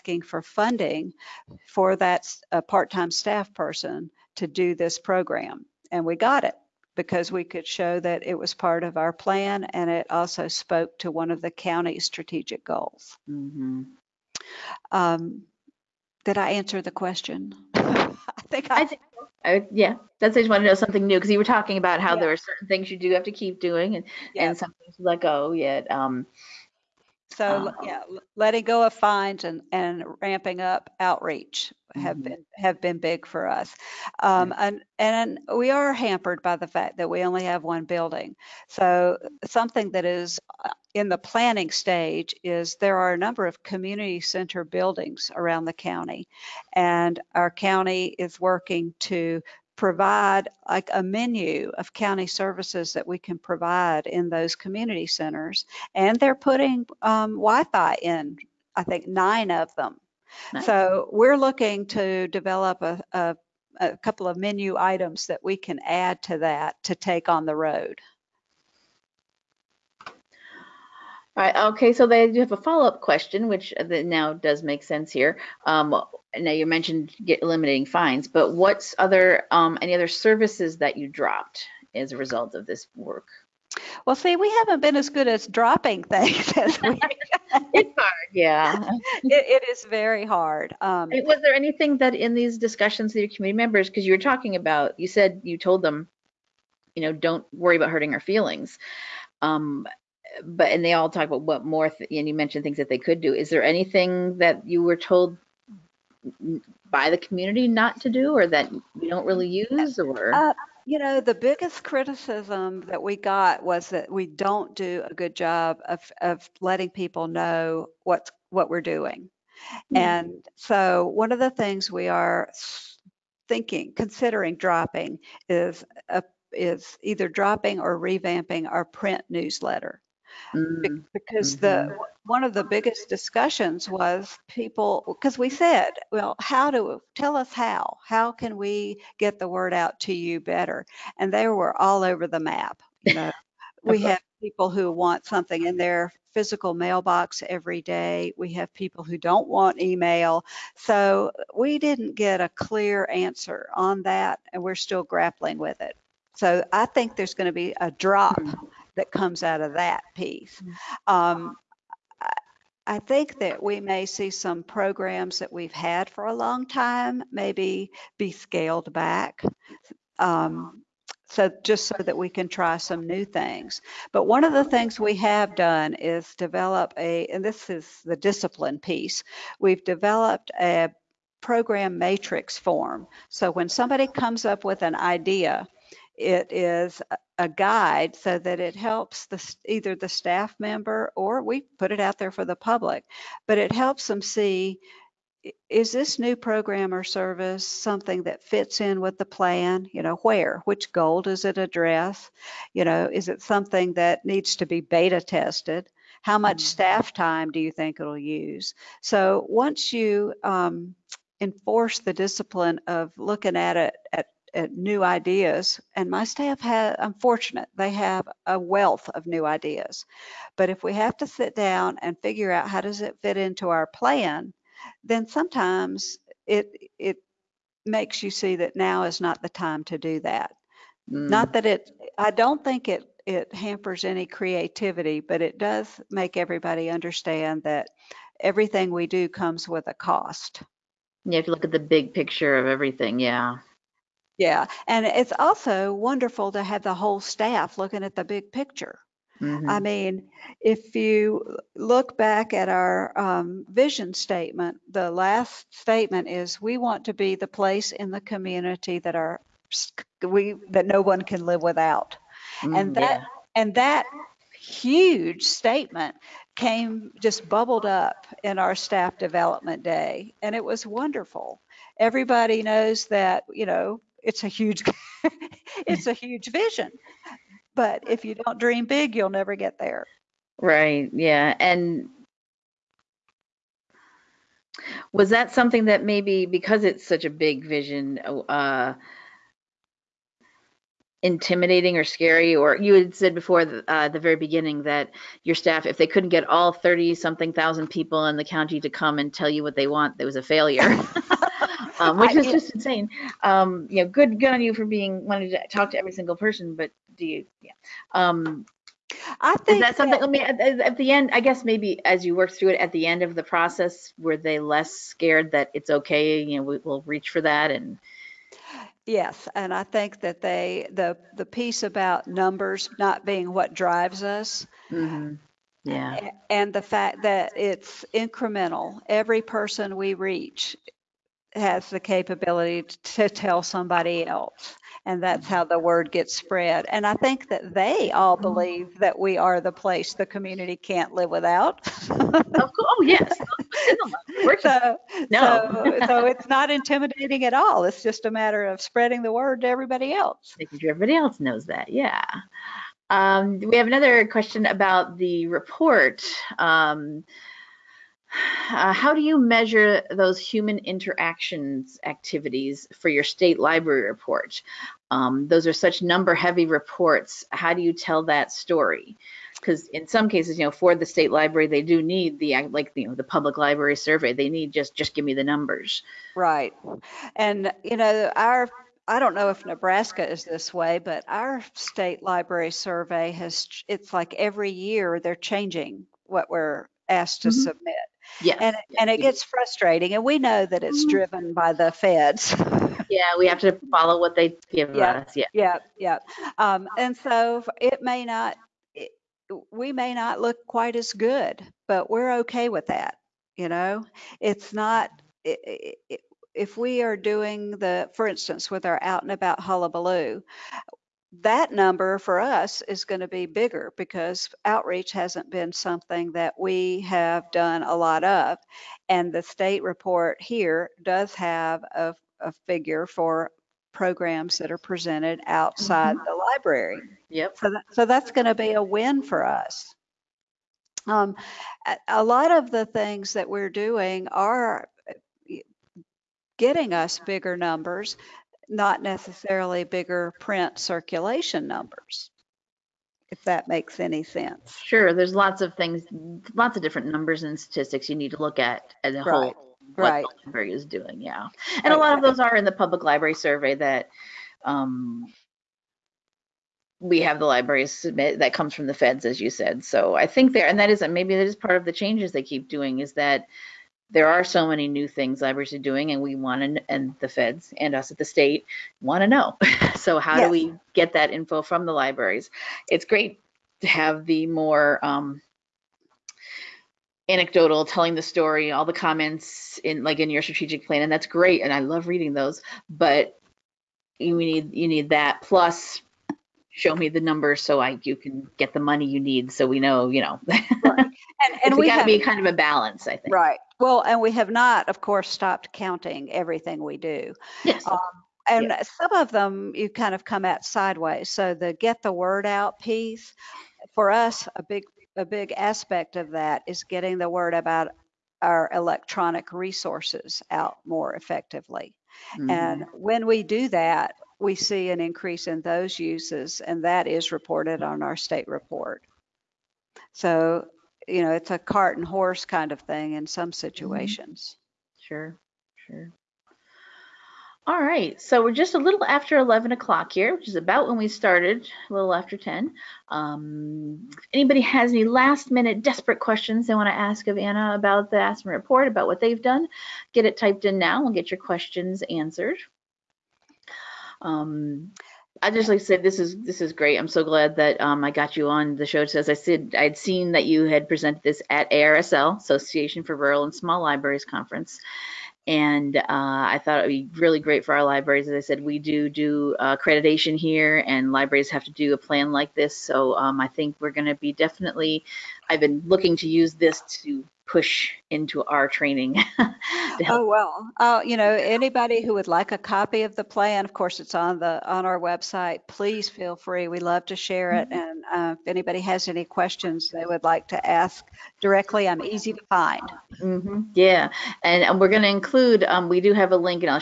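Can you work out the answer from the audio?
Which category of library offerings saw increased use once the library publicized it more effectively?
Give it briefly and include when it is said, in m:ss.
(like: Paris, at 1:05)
Electronic resources, at 8:28.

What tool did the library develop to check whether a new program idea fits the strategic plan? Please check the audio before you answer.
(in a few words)
Program matrix form.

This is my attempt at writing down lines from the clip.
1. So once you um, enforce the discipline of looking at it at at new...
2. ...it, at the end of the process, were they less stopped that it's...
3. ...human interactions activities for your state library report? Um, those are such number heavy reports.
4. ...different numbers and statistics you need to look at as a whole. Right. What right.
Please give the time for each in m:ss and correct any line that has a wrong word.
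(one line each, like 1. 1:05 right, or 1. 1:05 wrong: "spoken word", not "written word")
1. 3:29 right
2. 5:12 wrong: "scared", not "stopped"
3. 6:00 right
4. 7:26 right.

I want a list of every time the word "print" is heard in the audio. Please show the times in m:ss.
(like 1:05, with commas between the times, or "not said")
2:08, 7:20.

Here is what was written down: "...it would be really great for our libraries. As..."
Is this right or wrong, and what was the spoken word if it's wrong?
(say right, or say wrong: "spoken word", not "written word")
right.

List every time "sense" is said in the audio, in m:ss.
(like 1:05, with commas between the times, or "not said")
1:14, 7:24.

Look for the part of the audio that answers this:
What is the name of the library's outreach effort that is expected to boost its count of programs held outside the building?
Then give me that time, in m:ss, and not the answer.
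6:49.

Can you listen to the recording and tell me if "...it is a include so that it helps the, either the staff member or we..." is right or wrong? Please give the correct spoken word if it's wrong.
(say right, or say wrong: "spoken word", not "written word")
wrong: "guide", not "include".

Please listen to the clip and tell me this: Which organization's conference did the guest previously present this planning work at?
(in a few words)
Association for Rural and Small Libraries.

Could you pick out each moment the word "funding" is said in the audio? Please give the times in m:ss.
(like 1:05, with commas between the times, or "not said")
0:00.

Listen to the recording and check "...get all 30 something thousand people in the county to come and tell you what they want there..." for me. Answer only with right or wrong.
right.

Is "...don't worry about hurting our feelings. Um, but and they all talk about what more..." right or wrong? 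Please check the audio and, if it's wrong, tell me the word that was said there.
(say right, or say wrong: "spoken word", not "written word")
right.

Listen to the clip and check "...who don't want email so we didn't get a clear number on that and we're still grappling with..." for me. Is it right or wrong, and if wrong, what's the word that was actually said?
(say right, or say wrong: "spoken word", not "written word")
wrong: "answer", not "number".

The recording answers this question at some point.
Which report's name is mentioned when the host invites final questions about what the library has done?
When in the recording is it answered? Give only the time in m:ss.
8:58.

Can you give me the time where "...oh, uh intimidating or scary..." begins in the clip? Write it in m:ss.
4:48.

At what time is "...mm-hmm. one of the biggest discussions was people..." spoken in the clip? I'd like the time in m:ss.
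2:11.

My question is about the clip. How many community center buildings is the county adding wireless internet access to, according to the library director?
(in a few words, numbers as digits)
9.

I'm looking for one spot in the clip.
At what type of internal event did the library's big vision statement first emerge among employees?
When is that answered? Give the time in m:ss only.
4:28.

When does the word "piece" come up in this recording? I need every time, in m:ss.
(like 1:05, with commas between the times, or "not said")
2:40, 2:58, 5:21, 8:22.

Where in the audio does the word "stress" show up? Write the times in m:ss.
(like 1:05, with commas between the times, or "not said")
not said.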